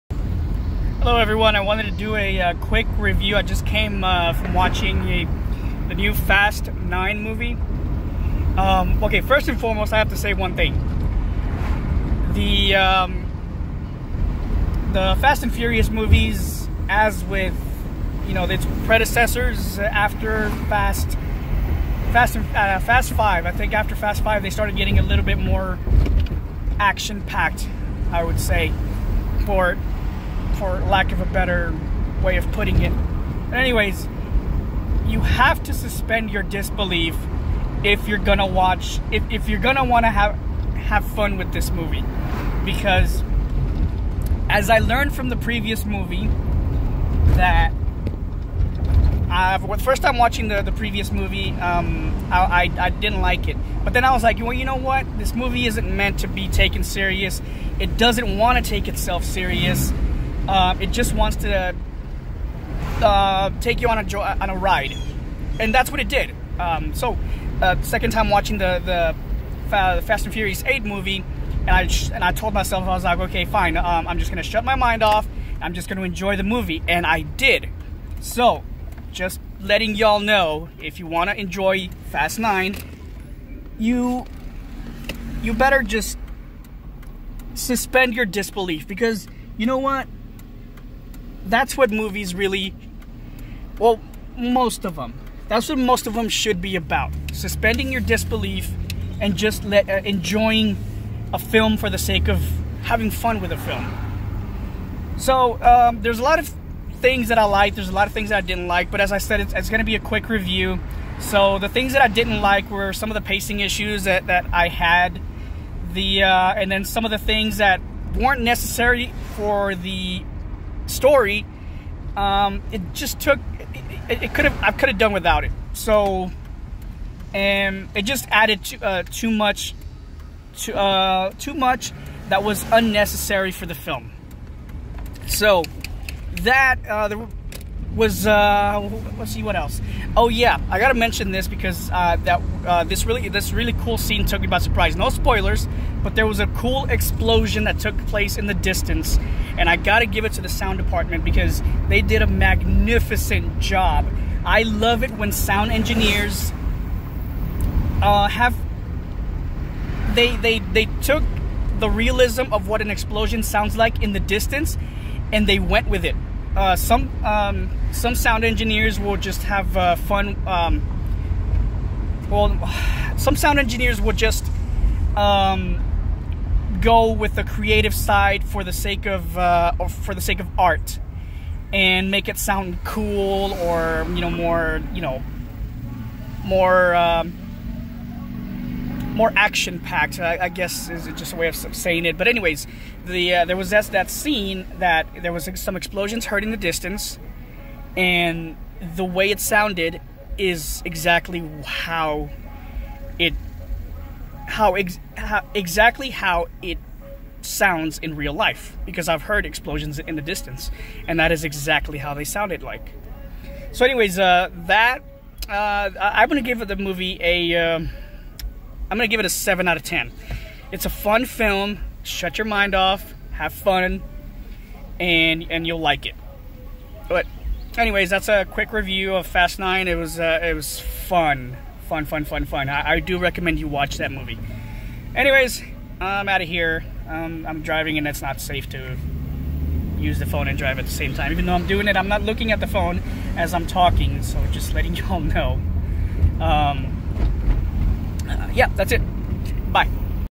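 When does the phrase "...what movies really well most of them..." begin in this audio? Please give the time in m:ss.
1:31.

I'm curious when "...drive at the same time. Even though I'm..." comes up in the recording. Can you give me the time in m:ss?
4:00.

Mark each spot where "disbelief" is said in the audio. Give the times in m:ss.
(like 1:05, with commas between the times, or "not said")
0:36, 1:28, 1:38.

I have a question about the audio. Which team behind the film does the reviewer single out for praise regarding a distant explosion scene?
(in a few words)
sound department.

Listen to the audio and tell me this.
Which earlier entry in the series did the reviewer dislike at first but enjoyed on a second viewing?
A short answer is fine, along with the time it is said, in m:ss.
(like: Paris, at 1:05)
Fast and Furious Eight, at 1:10.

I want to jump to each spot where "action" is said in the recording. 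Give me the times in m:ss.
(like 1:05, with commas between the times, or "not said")
0:26, 3:09.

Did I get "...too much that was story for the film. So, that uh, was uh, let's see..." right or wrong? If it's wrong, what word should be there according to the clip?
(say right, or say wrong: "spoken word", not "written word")
wrong: "unnecessary", not "story".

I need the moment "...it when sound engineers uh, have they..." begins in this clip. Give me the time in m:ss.
2:35.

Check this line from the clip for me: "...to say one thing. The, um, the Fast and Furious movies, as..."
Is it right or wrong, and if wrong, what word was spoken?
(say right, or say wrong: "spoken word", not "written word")
right.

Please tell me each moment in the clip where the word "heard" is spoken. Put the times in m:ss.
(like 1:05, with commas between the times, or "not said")
3:16, 3:29.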